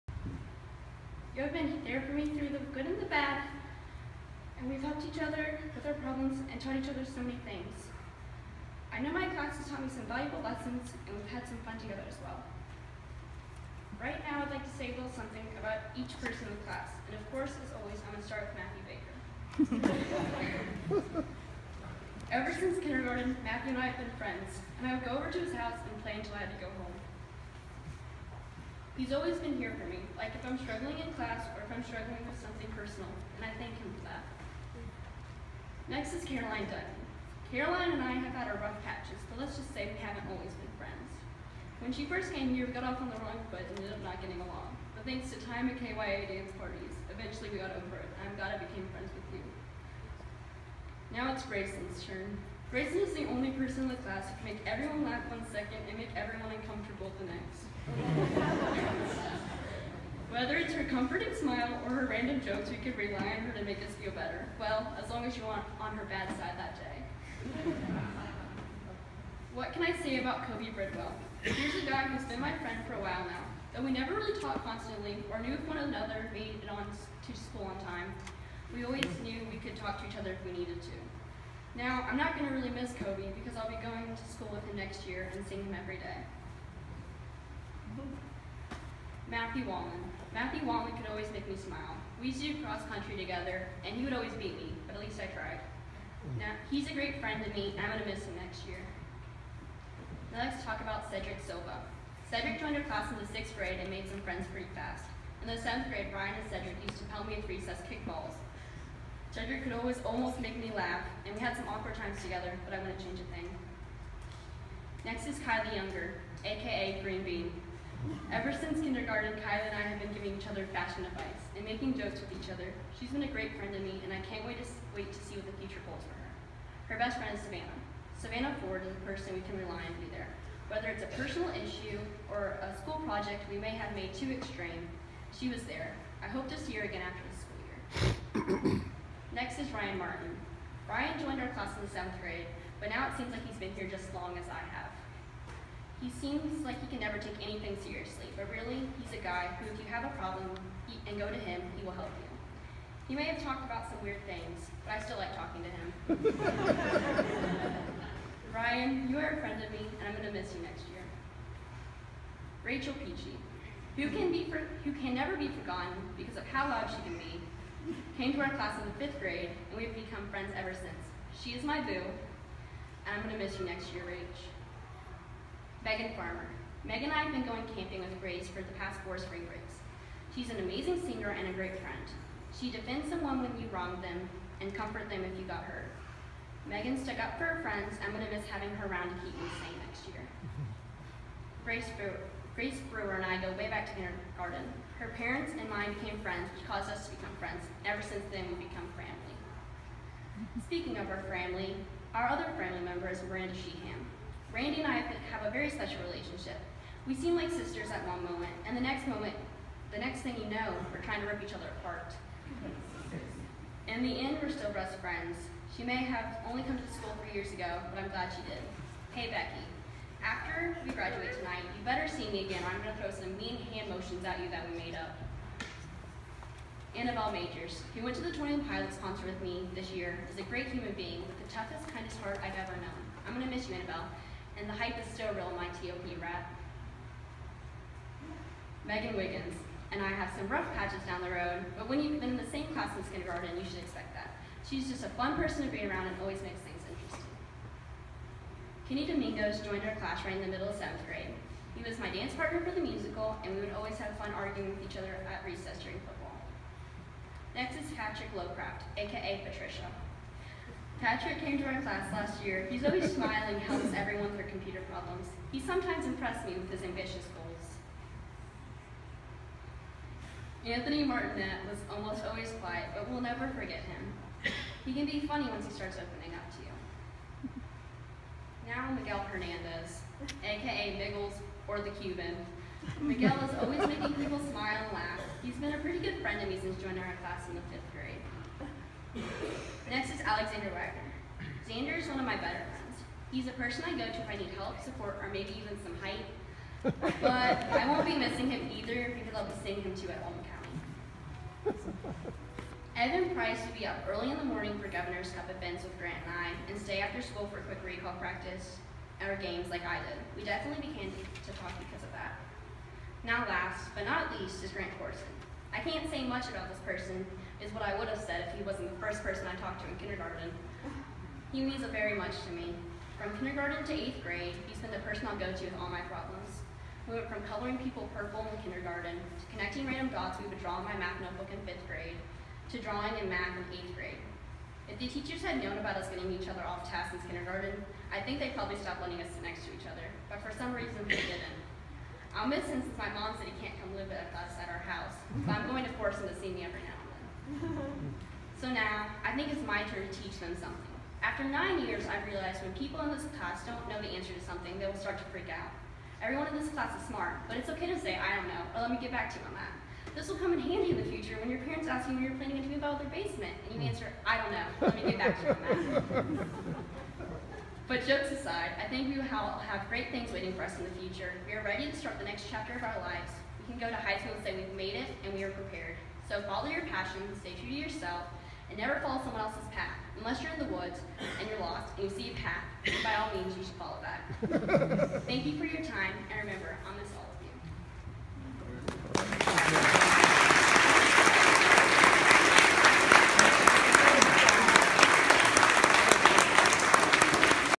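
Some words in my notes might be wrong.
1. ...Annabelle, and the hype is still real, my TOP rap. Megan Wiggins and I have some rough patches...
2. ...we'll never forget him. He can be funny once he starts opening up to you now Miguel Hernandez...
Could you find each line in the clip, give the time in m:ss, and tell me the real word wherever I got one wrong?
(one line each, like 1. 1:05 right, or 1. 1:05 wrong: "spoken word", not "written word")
1. 3:53 right
2. 4:33 right.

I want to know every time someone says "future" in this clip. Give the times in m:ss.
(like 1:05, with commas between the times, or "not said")
2:05, 6:10.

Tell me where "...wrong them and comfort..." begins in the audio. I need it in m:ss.
3:03.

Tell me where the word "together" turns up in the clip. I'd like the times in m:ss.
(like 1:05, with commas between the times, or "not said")
0:11, 1:33, 1:52.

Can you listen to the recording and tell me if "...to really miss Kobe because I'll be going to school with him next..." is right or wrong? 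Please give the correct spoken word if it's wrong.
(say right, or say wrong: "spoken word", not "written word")
right.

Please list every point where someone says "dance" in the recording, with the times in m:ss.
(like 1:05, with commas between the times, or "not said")
0:46, 4:12.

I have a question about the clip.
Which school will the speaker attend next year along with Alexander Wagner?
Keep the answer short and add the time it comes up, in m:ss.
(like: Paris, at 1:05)
Old County, at 5:00.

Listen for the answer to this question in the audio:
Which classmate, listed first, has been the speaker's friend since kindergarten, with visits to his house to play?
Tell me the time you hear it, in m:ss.
0:18.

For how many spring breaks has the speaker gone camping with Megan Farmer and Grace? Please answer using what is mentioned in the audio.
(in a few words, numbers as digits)
4.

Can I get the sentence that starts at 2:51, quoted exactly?
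She is my boo, and I'm going to miss you next year, Rach.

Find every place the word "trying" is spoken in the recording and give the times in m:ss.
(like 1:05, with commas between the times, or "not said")
3:31.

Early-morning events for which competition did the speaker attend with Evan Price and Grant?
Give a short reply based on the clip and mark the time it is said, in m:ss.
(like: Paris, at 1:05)
Governor's Cup, at 5:04.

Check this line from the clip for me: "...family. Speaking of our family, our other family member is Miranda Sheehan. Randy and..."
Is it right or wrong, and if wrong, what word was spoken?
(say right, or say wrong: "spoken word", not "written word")
right.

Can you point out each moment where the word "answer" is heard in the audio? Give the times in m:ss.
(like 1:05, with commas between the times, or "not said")
5:54, 6:03.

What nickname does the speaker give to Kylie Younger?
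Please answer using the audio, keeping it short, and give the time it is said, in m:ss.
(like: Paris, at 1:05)
Green Bean, at 1:57.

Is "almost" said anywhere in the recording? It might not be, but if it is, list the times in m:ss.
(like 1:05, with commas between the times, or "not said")
1:50, 4:31.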